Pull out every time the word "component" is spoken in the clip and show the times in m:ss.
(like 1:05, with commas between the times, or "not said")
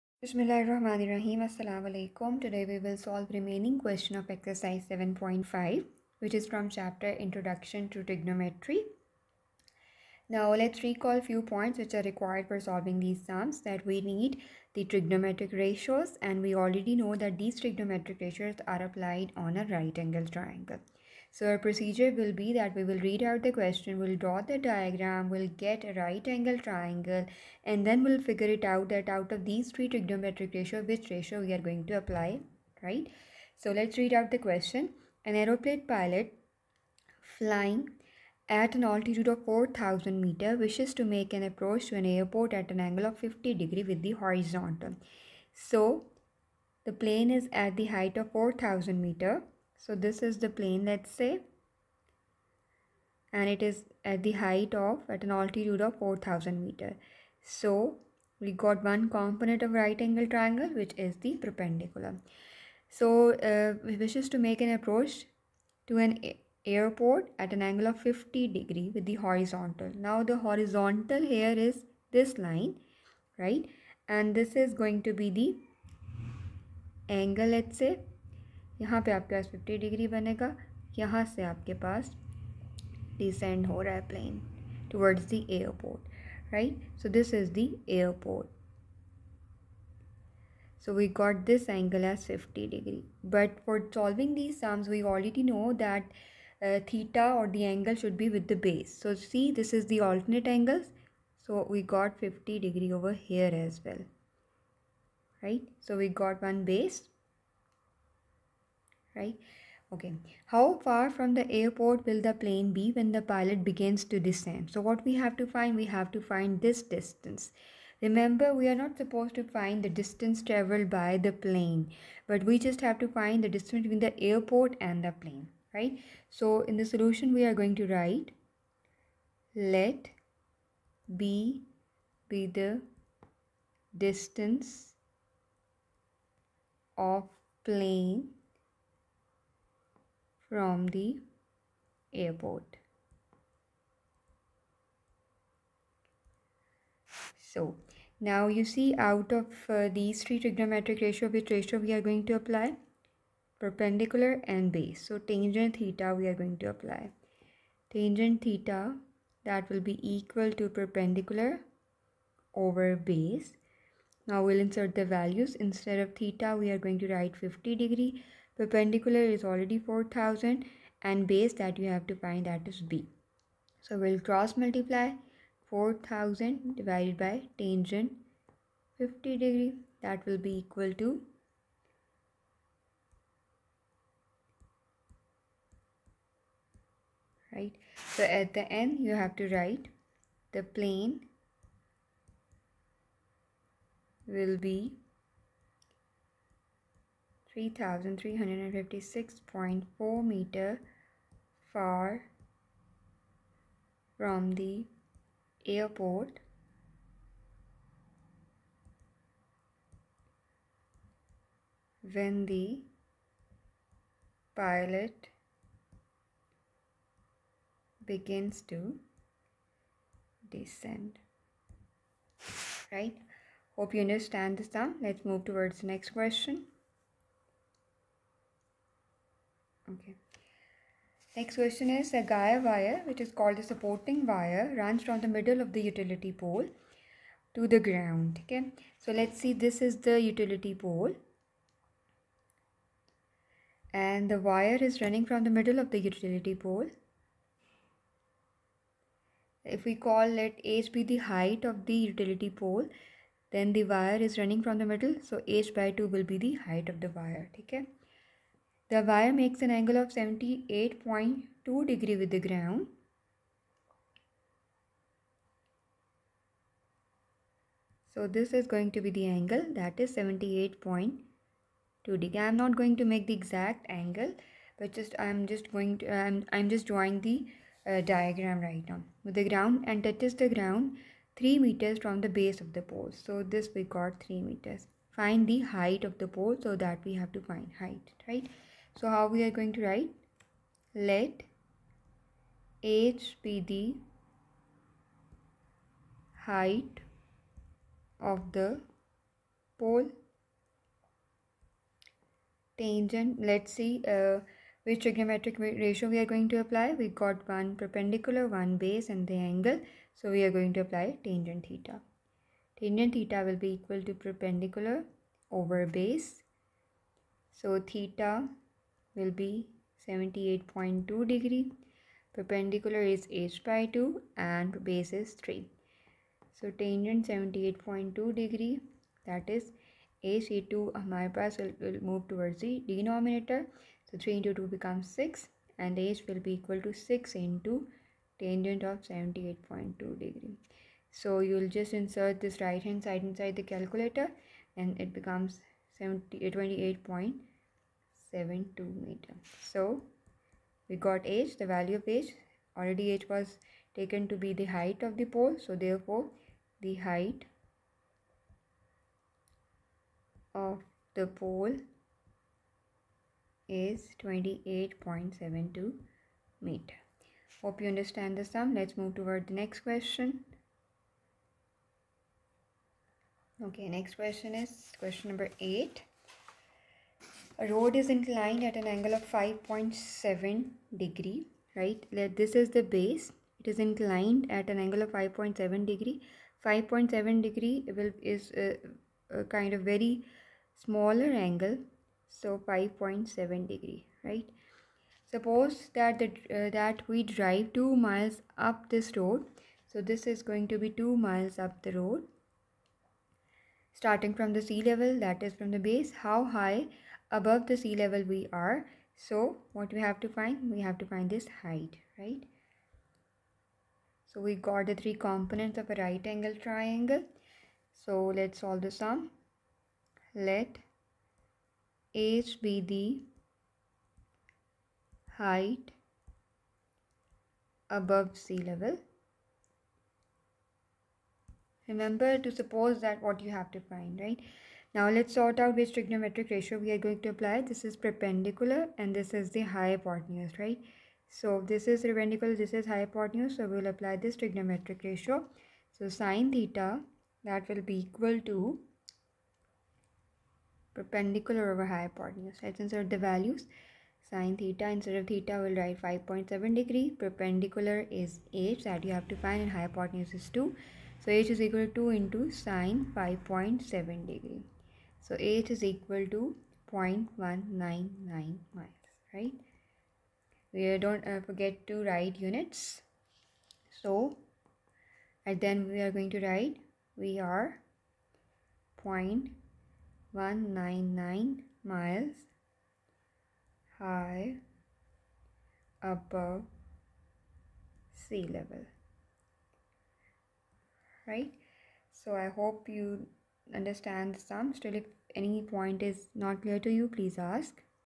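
0:59, 6:55.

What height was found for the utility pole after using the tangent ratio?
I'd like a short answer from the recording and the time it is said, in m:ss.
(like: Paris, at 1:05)
28.72 meters, at 6:04.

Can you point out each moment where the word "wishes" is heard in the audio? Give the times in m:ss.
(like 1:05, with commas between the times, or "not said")
0:40, 1:03.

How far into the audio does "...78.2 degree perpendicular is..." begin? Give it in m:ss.
5:20.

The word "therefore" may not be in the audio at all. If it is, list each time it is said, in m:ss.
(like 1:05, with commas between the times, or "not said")
5:55.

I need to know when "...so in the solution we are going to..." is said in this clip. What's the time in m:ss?
2:06.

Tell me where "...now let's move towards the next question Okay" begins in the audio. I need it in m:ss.
3:44.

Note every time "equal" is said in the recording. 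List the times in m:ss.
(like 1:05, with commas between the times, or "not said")
2:40, 3:00, 5:13, 5:36, 7:28, 7:41, 7:45.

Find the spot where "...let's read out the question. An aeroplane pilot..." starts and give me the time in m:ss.
0:33.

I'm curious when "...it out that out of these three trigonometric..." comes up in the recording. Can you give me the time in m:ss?
0:28.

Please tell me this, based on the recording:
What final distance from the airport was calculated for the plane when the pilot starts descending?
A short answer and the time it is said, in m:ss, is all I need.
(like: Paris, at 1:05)
3356.4 meters, at 3:17.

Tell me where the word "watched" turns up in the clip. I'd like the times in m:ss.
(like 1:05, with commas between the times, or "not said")
not said.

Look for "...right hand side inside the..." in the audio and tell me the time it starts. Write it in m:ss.
5:42.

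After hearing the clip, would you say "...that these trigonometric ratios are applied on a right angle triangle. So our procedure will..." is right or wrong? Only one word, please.
right.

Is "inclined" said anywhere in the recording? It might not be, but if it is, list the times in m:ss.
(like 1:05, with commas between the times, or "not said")
6:18, 6:23.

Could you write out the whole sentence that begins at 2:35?
So tangent theta we are going to apply.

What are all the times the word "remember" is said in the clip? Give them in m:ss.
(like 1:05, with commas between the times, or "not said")
1:58, 7:11.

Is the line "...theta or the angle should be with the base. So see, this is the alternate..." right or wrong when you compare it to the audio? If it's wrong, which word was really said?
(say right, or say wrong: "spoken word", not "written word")
right.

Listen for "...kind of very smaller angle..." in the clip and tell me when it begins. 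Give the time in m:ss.
6:29.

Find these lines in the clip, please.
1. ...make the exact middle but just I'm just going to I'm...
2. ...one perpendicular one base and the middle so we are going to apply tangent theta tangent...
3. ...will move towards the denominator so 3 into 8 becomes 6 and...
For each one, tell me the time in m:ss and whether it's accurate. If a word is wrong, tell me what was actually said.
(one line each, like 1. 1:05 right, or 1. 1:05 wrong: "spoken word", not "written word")
1. 4:33 wrong: "angle", not "middle"
2. 5:07 wrong: "angle", not "middle"
3. 5:31 wrong: "2", not "8".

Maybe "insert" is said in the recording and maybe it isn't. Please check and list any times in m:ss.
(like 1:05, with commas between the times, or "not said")
2:44, 5:41, 7:32.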